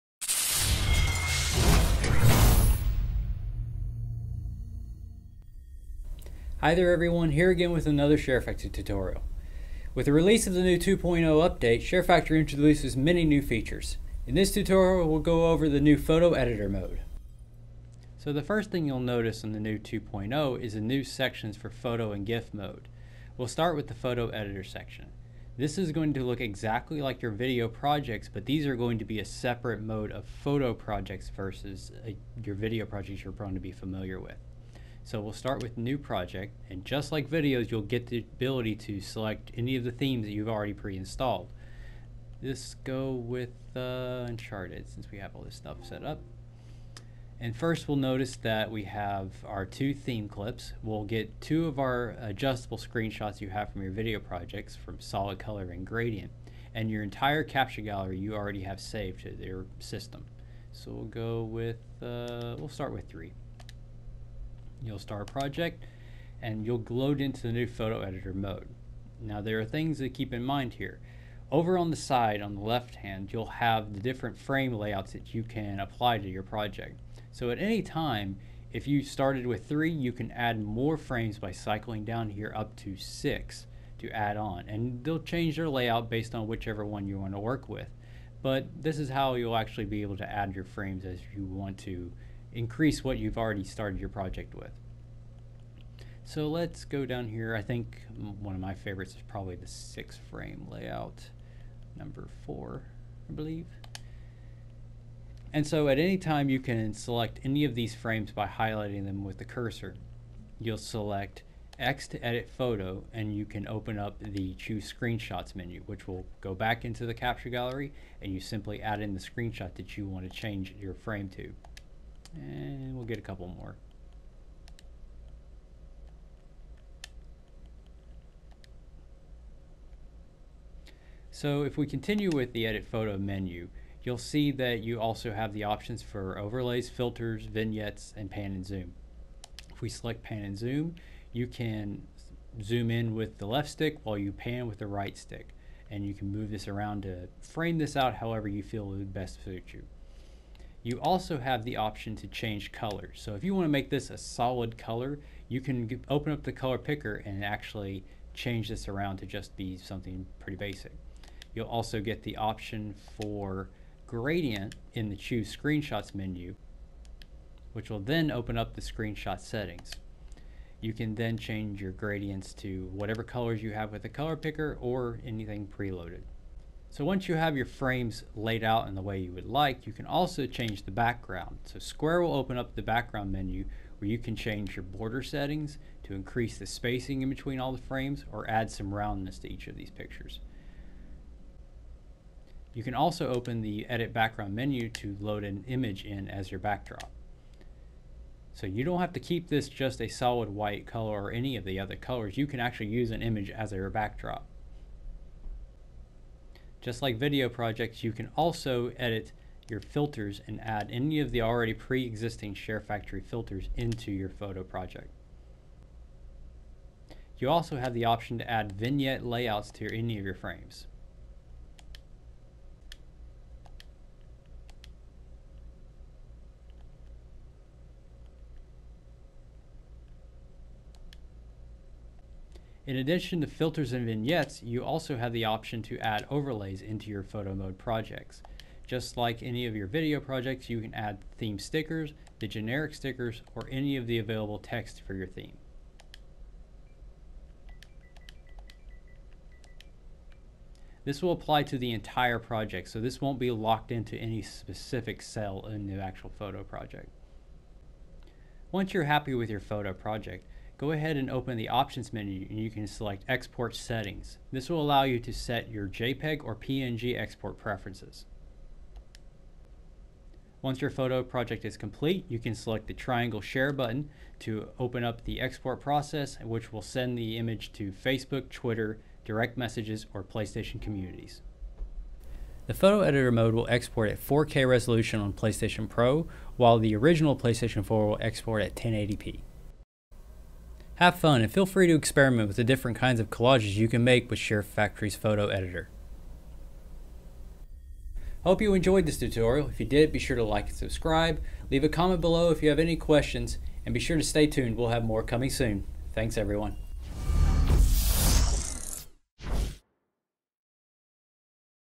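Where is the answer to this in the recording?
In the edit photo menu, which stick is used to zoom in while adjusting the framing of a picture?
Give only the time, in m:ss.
2:23.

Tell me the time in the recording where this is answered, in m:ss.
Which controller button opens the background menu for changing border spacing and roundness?
3:01.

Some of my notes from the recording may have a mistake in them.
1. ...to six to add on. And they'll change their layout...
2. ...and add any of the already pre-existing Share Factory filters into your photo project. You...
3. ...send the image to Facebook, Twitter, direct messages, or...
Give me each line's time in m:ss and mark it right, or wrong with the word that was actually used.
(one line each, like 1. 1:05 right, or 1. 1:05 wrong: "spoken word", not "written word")
1. 1:22 right
2. 3:30 right
3. 4:36 right.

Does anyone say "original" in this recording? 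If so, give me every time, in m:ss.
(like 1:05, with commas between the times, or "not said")
4:46.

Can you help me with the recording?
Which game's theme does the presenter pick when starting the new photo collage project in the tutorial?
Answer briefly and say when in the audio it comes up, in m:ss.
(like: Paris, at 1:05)
Uncharted, at 0:44.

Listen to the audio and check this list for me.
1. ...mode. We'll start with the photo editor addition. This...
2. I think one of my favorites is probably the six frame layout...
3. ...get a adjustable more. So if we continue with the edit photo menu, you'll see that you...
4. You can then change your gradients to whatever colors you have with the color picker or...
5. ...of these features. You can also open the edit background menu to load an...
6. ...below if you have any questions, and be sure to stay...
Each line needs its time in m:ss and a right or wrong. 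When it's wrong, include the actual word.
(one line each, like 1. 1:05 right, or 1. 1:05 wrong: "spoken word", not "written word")
1. 0:22 wrong: "section", not "addition"
2. 1:37 right
3. 2:03 wrong: "couple", not "adjustable"
4. 2:50 right
5. 3:09 wrong: "pictures", not "features"
6. 5:02 right.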